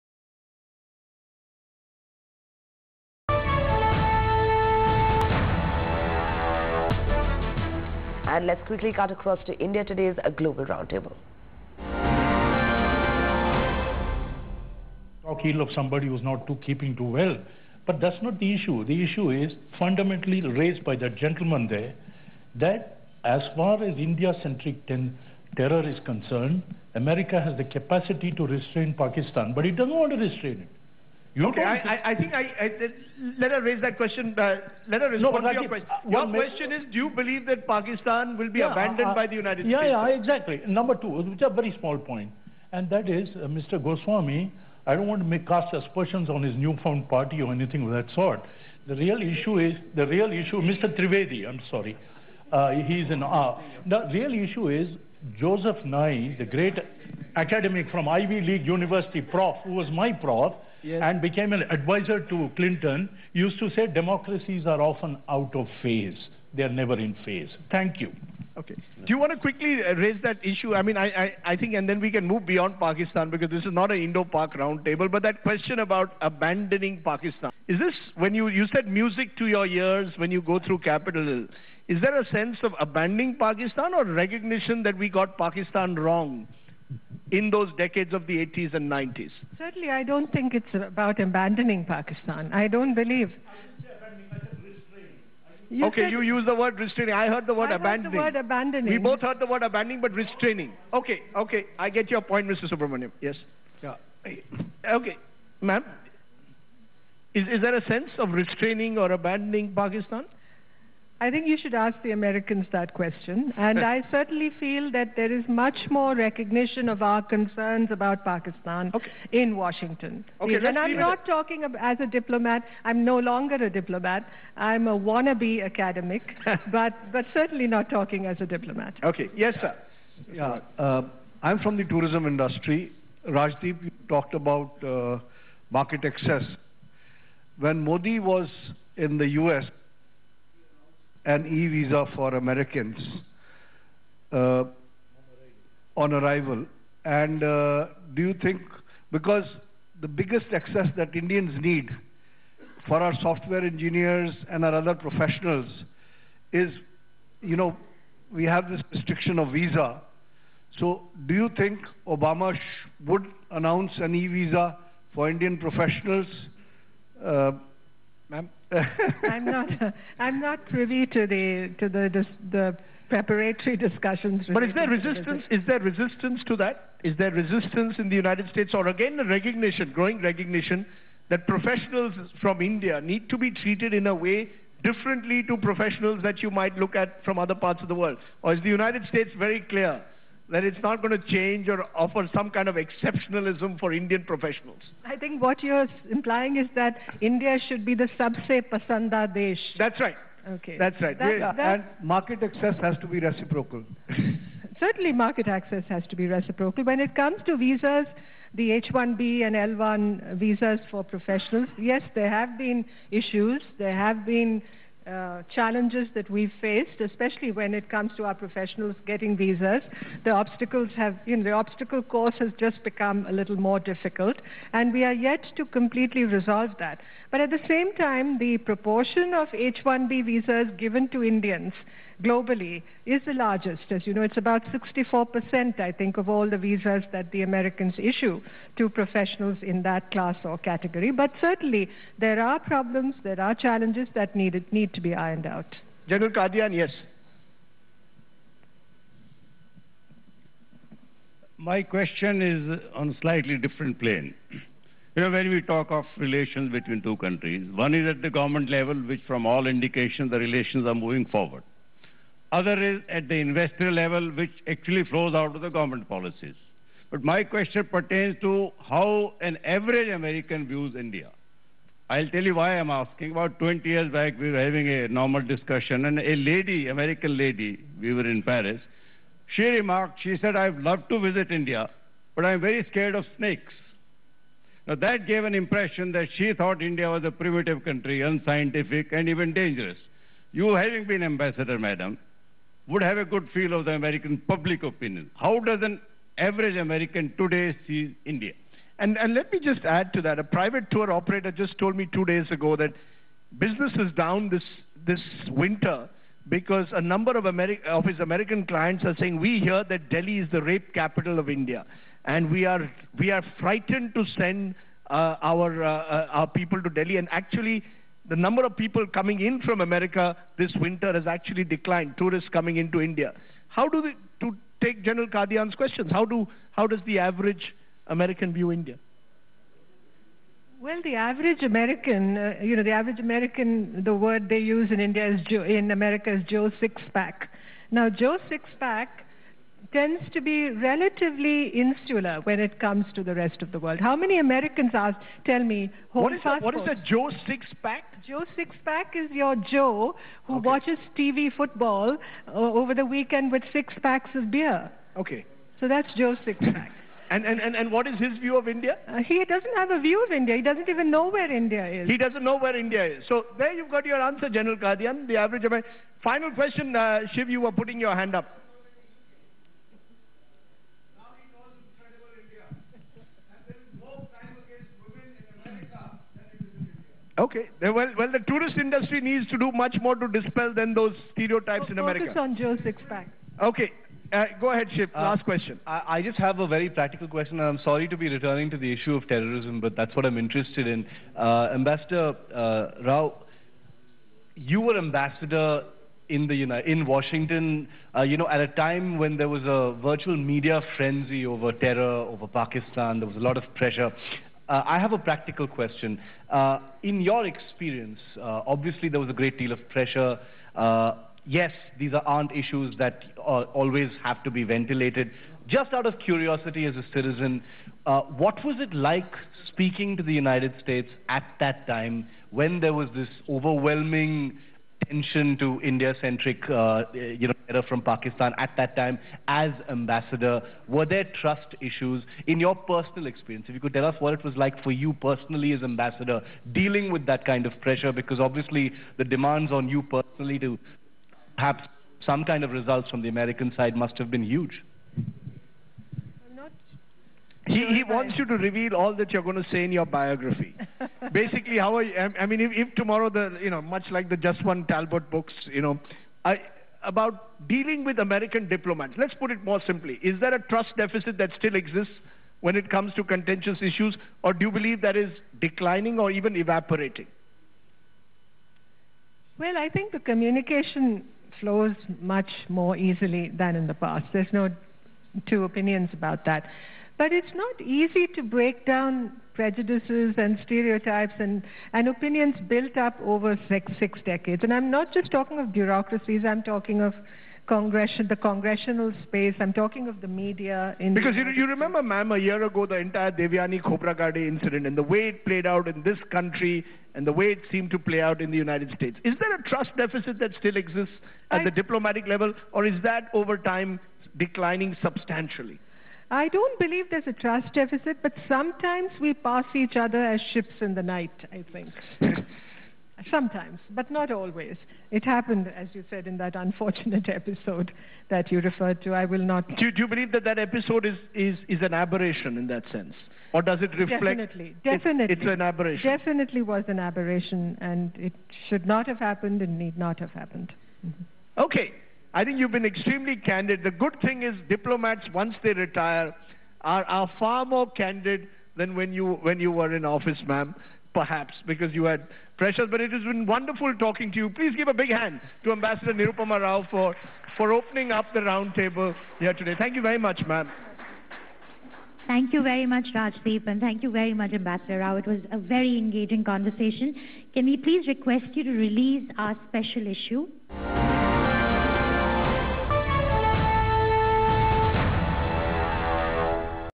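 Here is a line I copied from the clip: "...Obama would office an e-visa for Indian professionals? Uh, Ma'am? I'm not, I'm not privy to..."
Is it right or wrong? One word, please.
wrong.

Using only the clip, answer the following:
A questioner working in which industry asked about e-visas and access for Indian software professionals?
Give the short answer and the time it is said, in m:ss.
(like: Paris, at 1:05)
tourism industry, at 2:11.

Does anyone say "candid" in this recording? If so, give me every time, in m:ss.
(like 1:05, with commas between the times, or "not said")
8:53, 8:57.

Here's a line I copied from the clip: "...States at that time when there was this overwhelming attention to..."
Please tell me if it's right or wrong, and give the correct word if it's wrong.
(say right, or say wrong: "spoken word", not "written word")
right.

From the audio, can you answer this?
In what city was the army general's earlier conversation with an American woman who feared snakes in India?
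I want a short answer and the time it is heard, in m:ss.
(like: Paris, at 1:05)
Paris, at 4:38.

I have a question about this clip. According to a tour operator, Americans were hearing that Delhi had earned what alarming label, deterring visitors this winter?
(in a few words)
rape capital of India.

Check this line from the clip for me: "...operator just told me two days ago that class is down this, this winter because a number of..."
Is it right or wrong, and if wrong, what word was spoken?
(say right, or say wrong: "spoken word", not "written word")
wrong: "business", not "class".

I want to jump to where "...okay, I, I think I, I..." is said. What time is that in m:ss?
0:31.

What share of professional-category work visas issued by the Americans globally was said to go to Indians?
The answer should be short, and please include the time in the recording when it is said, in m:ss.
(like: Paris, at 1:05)
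64%, at 3:54.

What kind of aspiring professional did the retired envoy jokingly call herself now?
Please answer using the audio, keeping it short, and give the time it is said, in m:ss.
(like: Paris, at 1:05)
wannabe academic, at 2:04.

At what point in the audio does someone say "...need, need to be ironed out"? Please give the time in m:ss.
4:04.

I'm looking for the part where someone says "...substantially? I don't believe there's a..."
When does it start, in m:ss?
8:25.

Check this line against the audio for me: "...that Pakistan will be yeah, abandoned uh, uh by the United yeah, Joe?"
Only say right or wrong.
wrong.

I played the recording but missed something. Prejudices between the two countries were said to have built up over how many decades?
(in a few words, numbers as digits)
6.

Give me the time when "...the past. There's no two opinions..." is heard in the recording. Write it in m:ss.
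7:53.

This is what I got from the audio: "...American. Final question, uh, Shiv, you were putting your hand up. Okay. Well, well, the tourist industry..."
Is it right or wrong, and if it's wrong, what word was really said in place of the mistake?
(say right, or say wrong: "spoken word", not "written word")
right.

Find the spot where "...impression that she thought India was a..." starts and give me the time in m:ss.
4:45.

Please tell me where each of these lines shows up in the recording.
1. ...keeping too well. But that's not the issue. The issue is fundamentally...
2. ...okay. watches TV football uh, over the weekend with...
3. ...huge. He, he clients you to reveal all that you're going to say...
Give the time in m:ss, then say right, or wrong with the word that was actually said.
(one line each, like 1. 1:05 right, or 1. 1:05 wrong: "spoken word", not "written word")
1. 0:16 right
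2. 5:50 right
3. 7:24 wrong: "wants", not "clients".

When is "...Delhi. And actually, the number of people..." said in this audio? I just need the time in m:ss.
5:16.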